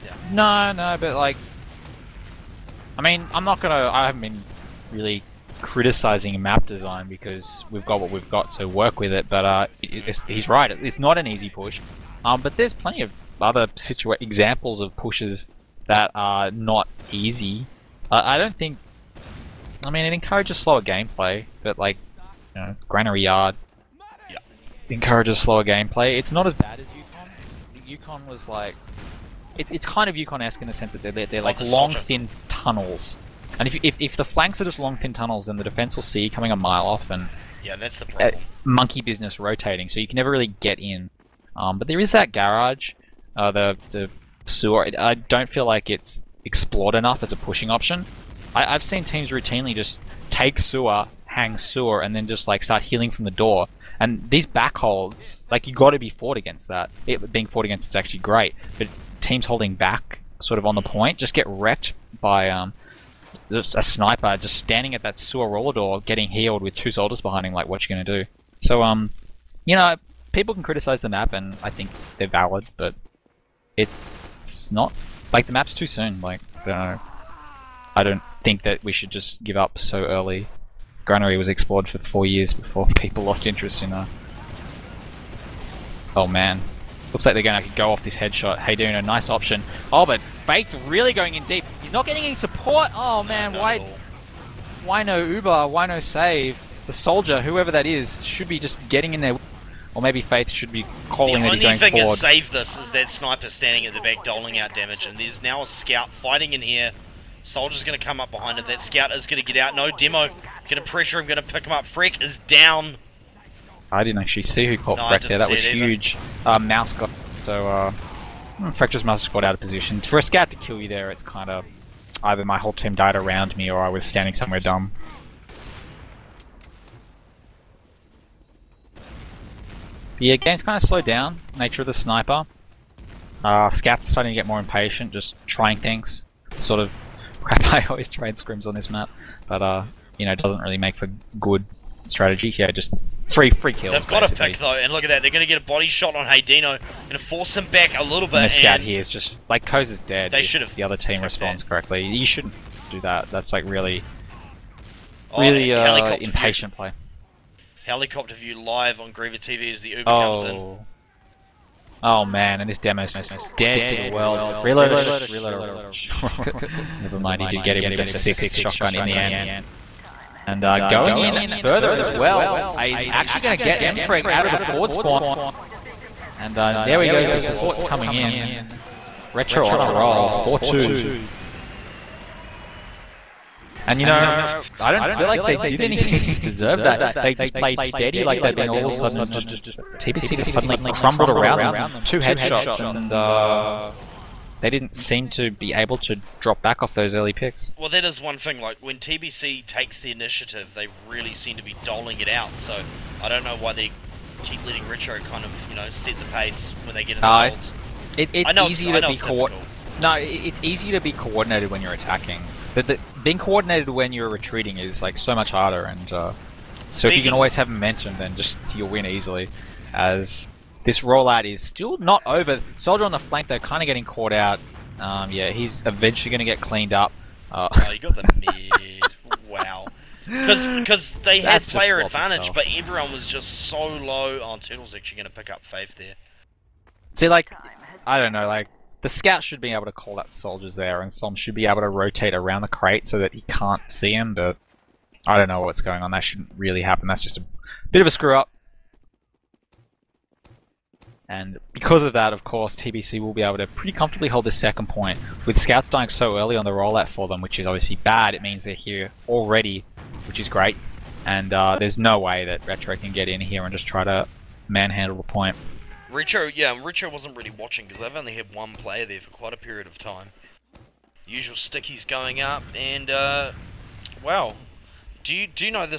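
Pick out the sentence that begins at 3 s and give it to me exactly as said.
I haven't been really criticizing map design because we've got what we've got, to work with it.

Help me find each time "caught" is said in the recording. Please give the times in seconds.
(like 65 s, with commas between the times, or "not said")
114 s, 209 s, 224 s.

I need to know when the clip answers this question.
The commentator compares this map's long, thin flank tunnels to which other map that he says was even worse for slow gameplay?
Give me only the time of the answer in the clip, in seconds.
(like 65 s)
30 s.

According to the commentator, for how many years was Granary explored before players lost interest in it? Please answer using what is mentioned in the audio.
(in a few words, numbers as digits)
4.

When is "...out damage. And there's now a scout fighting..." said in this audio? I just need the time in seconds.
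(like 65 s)
104 s.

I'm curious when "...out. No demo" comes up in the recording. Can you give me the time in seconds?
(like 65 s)
109 s.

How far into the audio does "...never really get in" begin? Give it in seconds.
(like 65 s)
40 s.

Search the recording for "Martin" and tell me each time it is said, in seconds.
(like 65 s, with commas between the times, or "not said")
not said.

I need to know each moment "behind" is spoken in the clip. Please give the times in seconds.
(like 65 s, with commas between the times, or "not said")
67 s, 108 s.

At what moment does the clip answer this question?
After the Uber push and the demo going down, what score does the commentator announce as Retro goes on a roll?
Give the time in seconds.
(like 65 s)
180 s.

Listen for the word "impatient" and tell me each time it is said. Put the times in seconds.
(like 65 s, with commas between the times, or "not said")
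134 s, 156 s.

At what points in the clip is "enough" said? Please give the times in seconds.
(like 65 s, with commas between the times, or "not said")
46 s.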